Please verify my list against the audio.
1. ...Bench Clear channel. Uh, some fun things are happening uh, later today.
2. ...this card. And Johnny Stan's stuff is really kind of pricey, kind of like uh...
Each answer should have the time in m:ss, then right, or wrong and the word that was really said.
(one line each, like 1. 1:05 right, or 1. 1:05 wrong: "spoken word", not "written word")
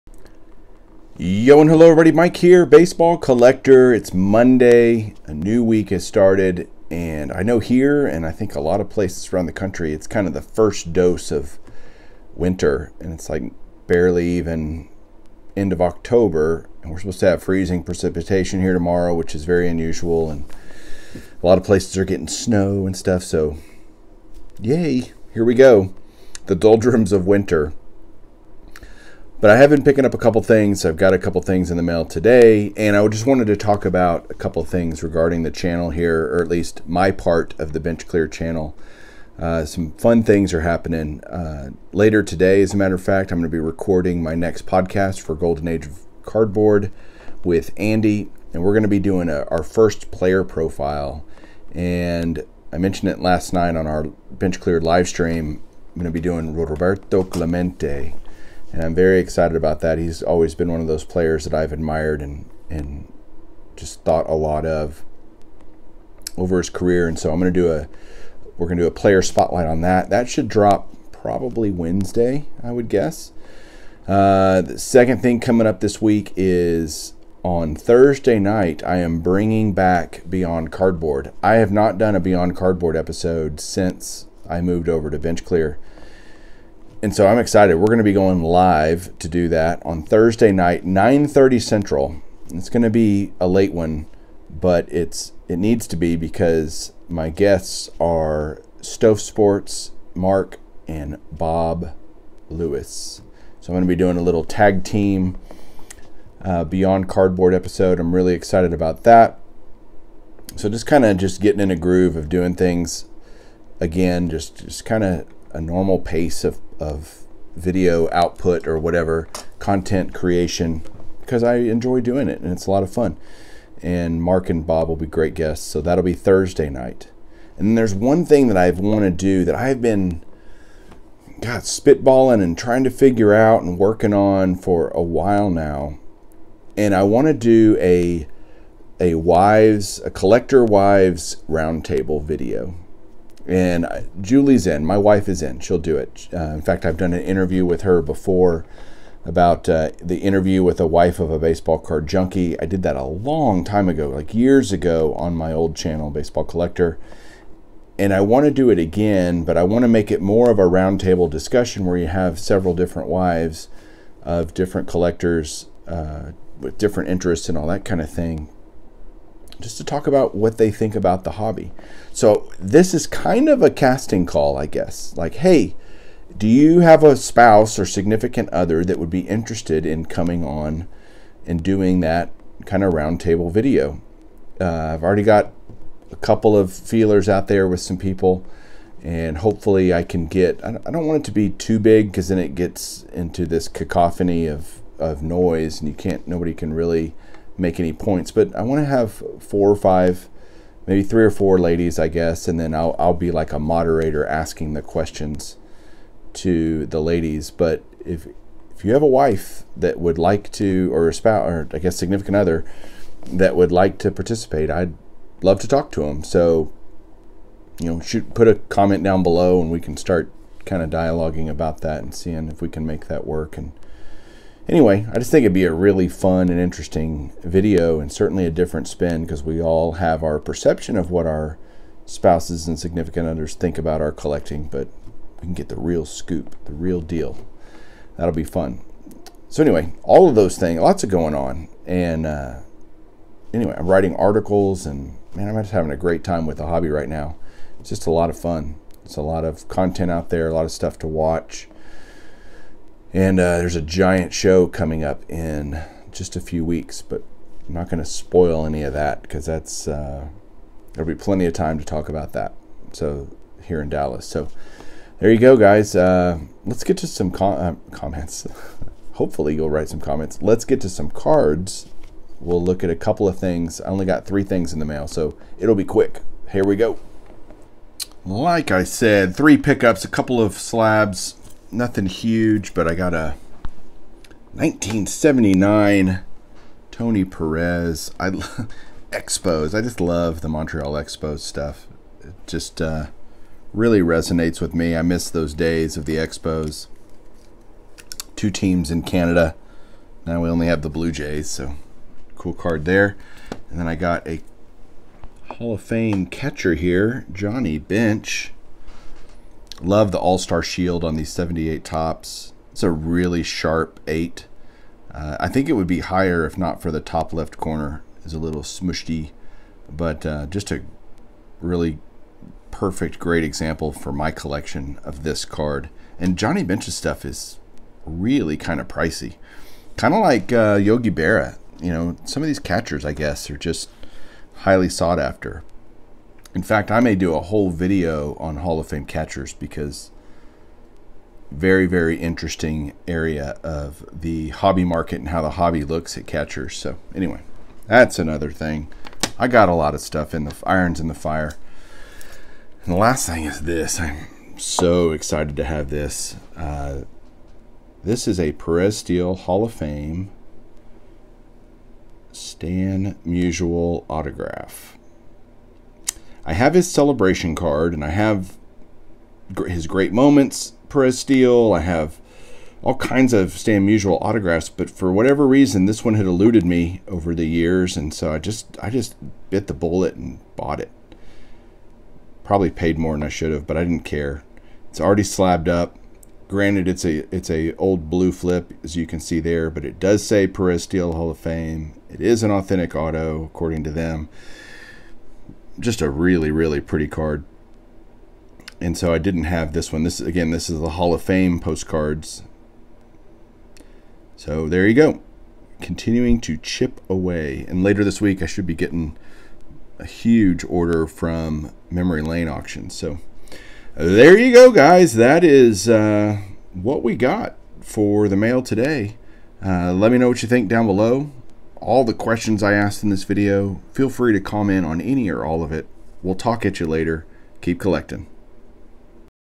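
1. 0:37 right
2. 5:25 wrong: "Bench", not "Stan".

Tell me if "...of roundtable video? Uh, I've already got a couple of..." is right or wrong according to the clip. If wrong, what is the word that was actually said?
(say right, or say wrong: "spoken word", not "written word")
right.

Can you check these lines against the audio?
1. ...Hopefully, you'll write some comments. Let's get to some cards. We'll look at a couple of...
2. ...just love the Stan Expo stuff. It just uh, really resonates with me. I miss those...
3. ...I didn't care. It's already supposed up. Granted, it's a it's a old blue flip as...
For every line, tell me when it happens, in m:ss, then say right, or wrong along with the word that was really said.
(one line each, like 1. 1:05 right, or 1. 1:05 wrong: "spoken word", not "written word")
1. 4:29 right
2. 4:49 wrong: "Montreal", not "Stan"
3. 6:23 wrong: "slabbed", not "supposed".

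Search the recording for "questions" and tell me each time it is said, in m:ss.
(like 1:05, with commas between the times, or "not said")
3:24, 7:02.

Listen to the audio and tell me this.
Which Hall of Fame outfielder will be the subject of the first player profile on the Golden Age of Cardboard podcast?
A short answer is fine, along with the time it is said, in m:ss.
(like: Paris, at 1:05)
Roberto Clemente, at 0:56.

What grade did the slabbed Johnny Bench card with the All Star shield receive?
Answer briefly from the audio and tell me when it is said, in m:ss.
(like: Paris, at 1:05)
8, at 5:14.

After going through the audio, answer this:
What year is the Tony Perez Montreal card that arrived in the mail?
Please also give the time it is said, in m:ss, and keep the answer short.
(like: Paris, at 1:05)
1979, at 4:44.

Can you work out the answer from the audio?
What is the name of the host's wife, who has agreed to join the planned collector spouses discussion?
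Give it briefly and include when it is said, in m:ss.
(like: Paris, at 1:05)
Julie, at 2:24.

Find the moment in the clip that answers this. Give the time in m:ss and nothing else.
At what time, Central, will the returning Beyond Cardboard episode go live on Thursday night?
1:30.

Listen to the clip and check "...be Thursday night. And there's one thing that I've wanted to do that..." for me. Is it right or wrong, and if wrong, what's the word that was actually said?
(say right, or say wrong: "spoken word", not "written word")
right.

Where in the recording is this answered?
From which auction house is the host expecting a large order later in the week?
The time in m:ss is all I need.
6:51.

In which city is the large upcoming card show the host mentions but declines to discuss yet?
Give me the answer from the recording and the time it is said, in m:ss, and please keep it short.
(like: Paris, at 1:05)
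Dallas, at 4:23.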